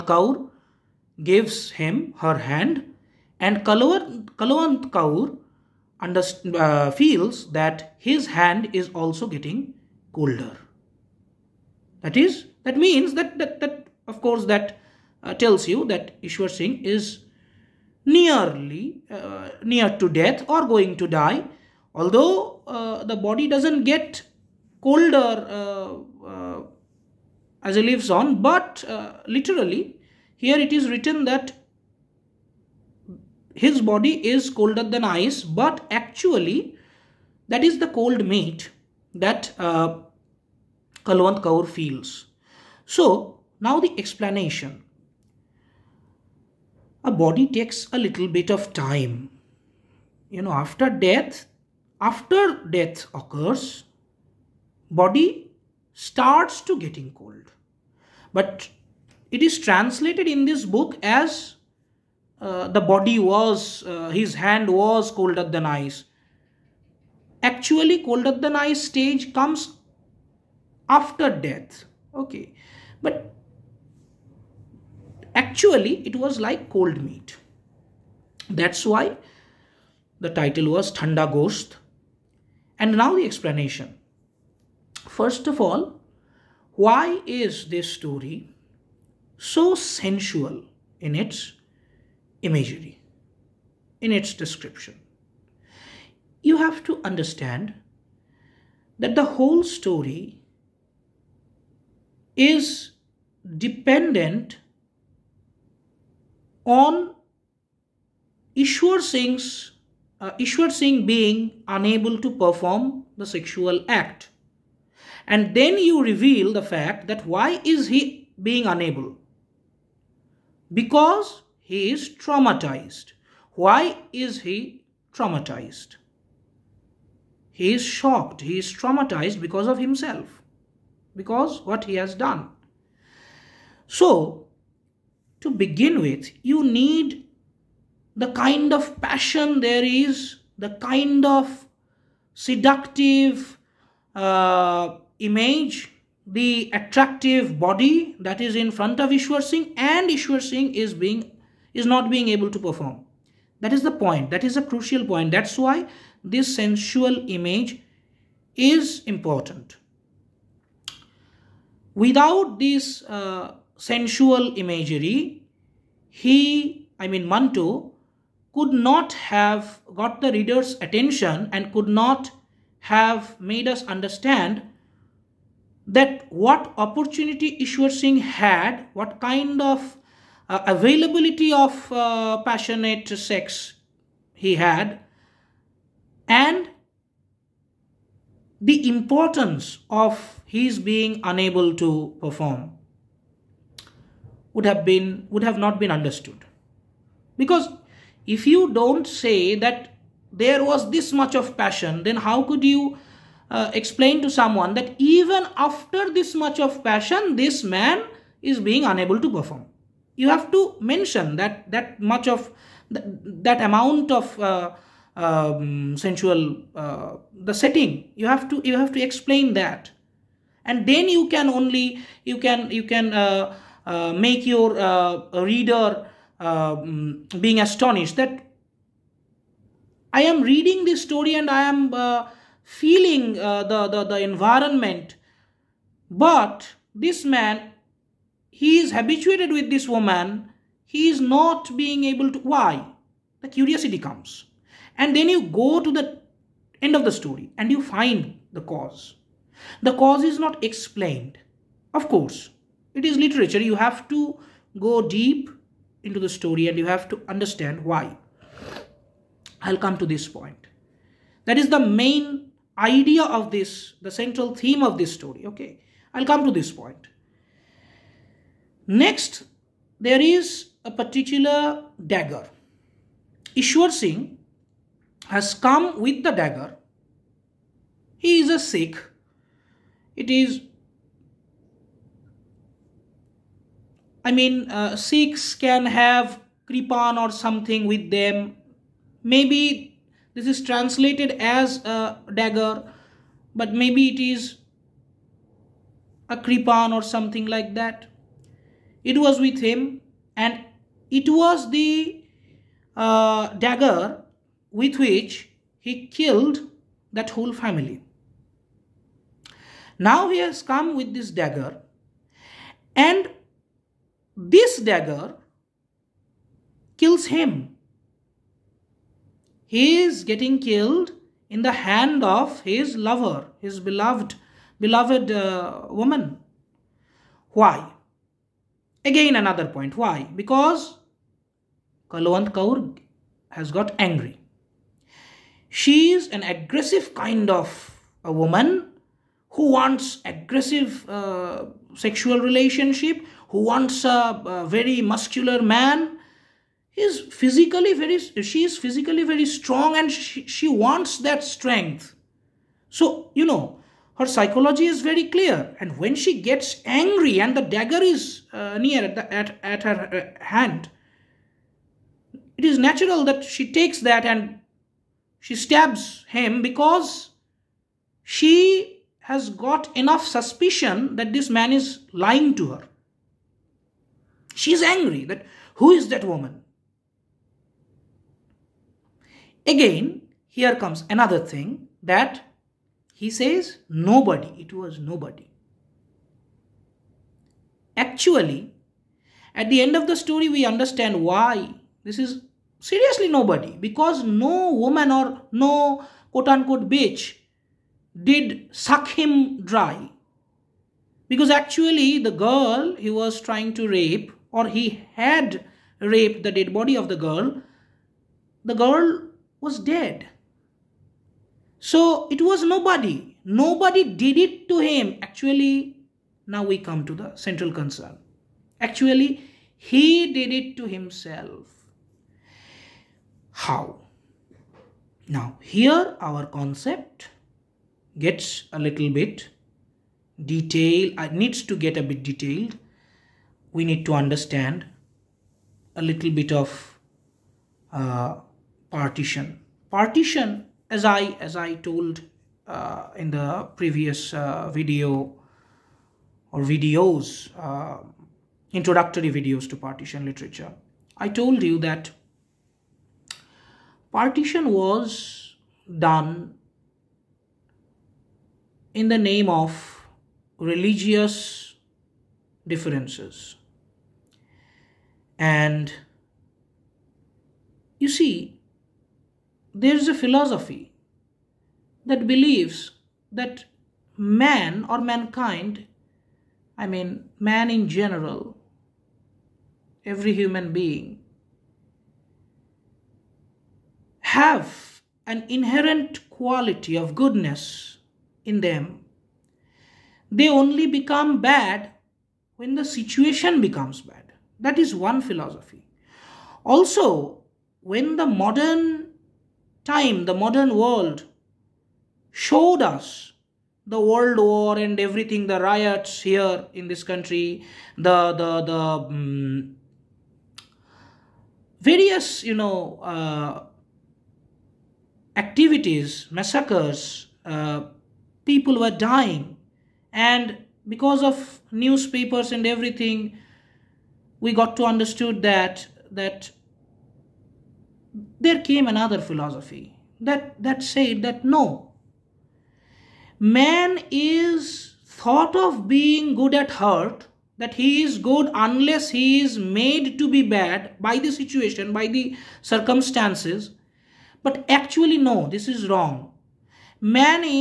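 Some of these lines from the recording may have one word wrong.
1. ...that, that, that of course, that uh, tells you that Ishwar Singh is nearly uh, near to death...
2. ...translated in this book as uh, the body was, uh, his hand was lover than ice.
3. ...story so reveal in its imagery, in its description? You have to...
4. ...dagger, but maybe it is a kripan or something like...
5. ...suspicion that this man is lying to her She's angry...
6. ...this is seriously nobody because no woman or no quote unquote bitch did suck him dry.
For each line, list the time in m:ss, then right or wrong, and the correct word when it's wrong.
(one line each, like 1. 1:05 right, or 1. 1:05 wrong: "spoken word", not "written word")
1. 0:13 right
2. 0:59 wrong: "colder", not "lover"
3. 1:27 wrong: "sensual", not "reveal"
4. 4:52 right
5. 6:10 right
6. 6:32 right.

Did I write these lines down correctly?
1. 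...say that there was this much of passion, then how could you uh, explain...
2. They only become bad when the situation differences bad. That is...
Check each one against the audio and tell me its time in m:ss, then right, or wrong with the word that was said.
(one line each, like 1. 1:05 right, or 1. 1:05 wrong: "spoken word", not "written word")
1. 3:19 right
2. 8:10 wrong: "becomes", not "differences".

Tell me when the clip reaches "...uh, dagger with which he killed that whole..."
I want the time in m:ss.
5:02.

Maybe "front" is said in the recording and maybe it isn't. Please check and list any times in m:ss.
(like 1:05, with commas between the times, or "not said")
2:28.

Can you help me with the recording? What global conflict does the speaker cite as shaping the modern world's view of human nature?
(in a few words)
the world war.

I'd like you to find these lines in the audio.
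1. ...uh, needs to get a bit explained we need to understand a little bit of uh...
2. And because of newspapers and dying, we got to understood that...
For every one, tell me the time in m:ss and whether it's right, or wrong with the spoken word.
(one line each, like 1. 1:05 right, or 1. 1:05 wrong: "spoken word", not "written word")
1. 7:11 wrong: "detailed", not "explained"
2. 8:40 wrong: "everything", not "dying".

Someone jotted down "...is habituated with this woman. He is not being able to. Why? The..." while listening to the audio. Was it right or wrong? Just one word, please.
right.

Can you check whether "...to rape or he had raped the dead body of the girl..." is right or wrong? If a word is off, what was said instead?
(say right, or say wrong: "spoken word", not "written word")
right.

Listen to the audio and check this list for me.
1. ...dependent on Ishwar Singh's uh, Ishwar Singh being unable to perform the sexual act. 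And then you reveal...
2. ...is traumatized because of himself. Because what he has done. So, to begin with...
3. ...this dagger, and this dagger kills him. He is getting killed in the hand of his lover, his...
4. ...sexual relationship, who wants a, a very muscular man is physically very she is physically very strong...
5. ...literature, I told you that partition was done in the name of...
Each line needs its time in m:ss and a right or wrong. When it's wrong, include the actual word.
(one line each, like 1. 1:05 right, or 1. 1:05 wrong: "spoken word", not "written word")
1. 1:43 right
2. 2:08 right
3. 5:11 right
4. 5:41 right
5. 7:30 right.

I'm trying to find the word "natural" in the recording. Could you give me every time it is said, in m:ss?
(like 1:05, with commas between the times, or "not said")
6:02.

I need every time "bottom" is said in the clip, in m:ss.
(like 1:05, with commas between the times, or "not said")
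not said.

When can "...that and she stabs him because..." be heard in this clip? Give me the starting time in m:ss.
6:03.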